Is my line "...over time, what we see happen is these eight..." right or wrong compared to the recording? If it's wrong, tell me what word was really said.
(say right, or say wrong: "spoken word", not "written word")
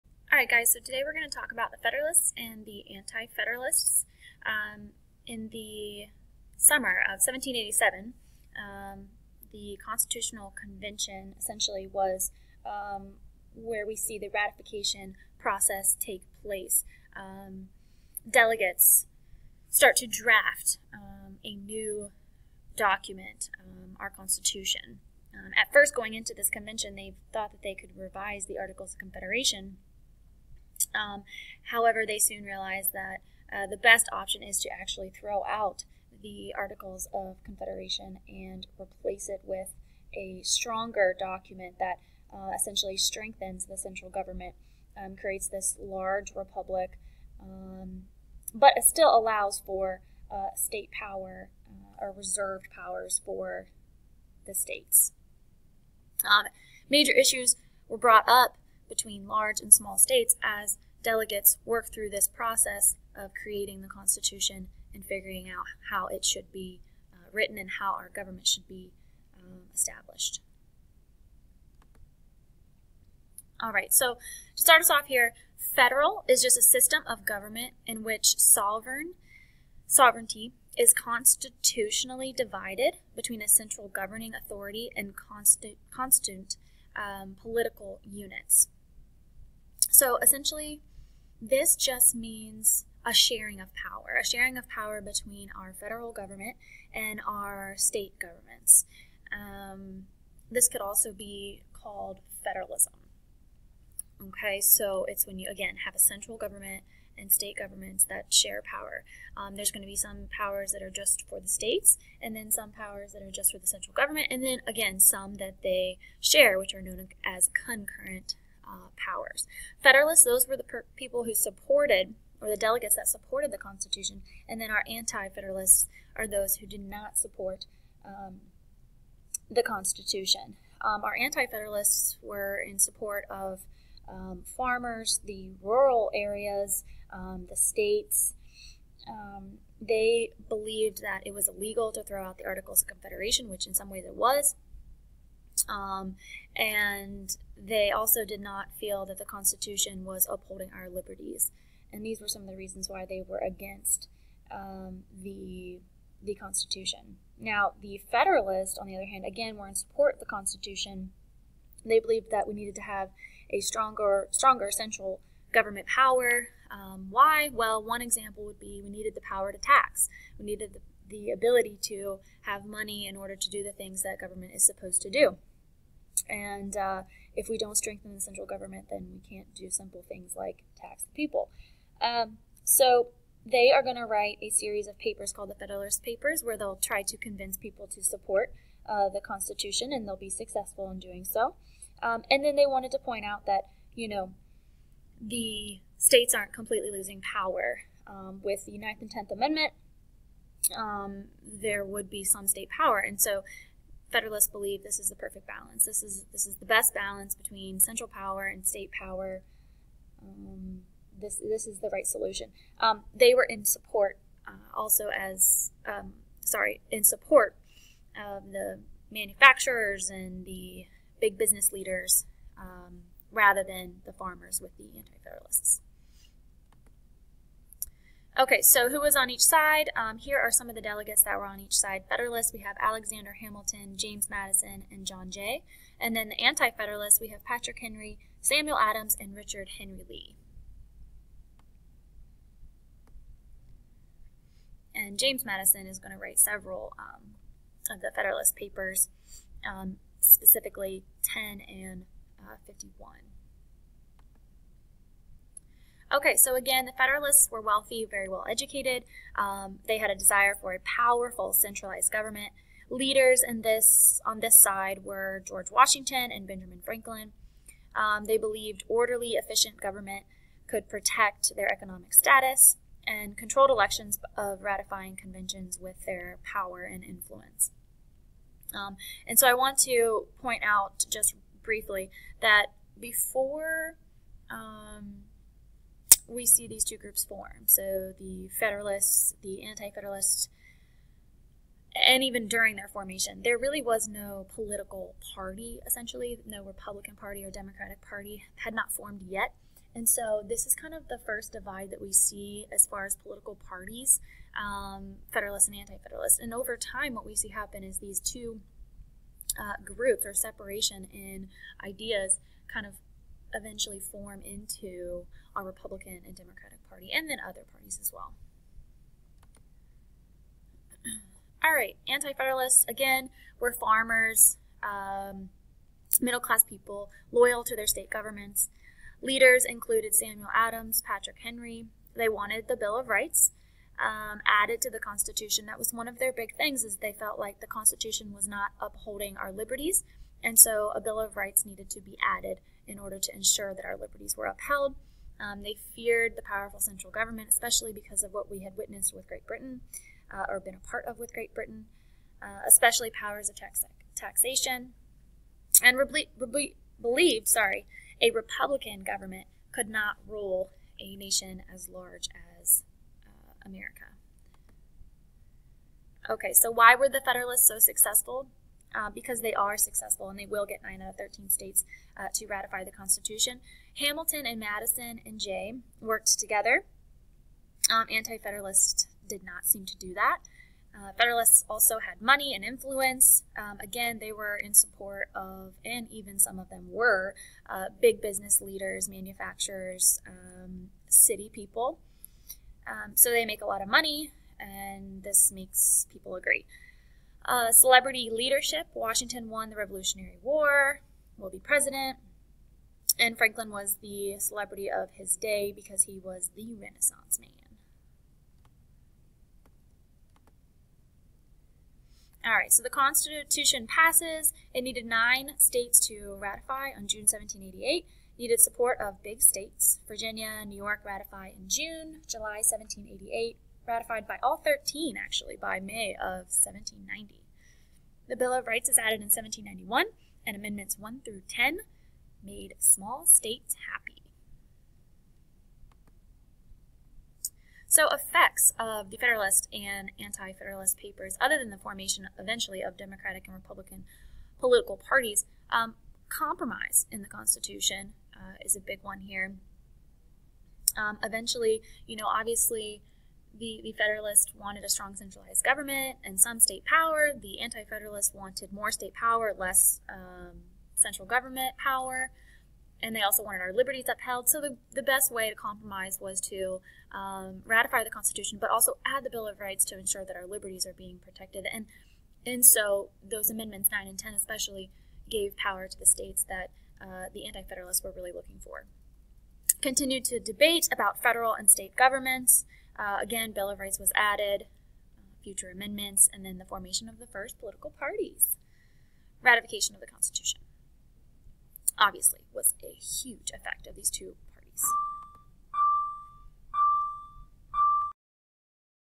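wrong: "two", not "eight".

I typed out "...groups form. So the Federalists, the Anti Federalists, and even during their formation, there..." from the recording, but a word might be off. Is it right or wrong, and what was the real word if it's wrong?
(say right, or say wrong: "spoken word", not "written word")
right.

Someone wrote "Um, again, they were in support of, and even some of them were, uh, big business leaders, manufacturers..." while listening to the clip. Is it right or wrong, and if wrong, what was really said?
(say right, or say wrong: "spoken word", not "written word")
right.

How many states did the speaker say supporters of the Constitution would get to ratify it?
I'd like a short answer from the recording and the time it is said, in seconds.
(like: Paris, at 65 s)
9, at 370 s.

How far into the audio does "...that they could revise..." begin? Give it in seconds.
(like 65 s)
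27 s.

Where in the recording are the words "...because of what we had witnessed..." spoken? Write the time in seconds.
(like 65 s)
347 s.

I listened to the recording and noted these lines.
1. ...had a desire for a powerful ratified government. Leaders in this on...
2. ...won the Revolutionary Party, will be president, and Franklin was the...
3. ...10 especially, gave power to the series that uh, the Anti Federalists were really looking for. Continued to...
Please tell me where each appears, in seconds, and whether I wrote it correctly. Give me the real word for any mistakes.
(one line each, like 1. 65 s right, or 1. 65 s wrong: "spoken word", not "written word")
1. 259 s wrong: "centralized", not "ratified"
2. 399 s wrong: "War", not "Party"
3. 474 s wrong: "states", not "series".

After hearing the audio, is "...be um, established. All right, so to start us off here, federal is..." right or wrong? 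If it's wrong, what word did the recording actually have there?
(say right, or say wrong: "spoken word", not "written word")
right.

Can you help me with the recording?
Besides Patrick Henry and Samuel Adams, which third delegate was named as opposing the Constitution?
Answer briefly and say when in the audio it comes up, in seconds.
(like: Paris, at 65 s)
Richard Henry Lee, at 239 s.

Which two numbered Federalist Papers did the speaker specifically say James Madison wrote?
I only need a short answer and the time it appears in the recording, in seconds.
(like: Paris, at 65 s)
10 and 51, at 251 s.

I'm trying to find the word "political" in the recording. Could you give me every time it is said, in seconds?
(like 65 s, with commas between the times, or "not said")
87 s, 294 s, 303 s, 444 s, 487 s.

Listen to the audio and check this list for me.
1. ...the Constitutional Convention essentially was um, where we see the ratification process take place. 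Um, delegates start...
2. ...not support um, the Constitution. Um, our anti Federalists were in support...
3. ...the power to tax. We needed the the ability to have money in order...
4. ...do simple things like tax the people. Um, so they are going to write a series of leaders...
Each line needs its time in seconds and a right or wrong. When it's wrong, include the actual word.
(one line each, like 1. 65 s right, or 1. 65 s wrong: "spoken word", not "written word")
1. 9 s right
2. 126 s right
3. 169 s right
4. 179 s wrong: "papers", not "leaders".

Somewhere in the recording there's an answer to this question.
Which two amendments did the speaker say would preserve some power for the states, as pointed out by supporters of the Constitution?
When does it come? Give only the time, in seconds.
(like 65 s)
198 s.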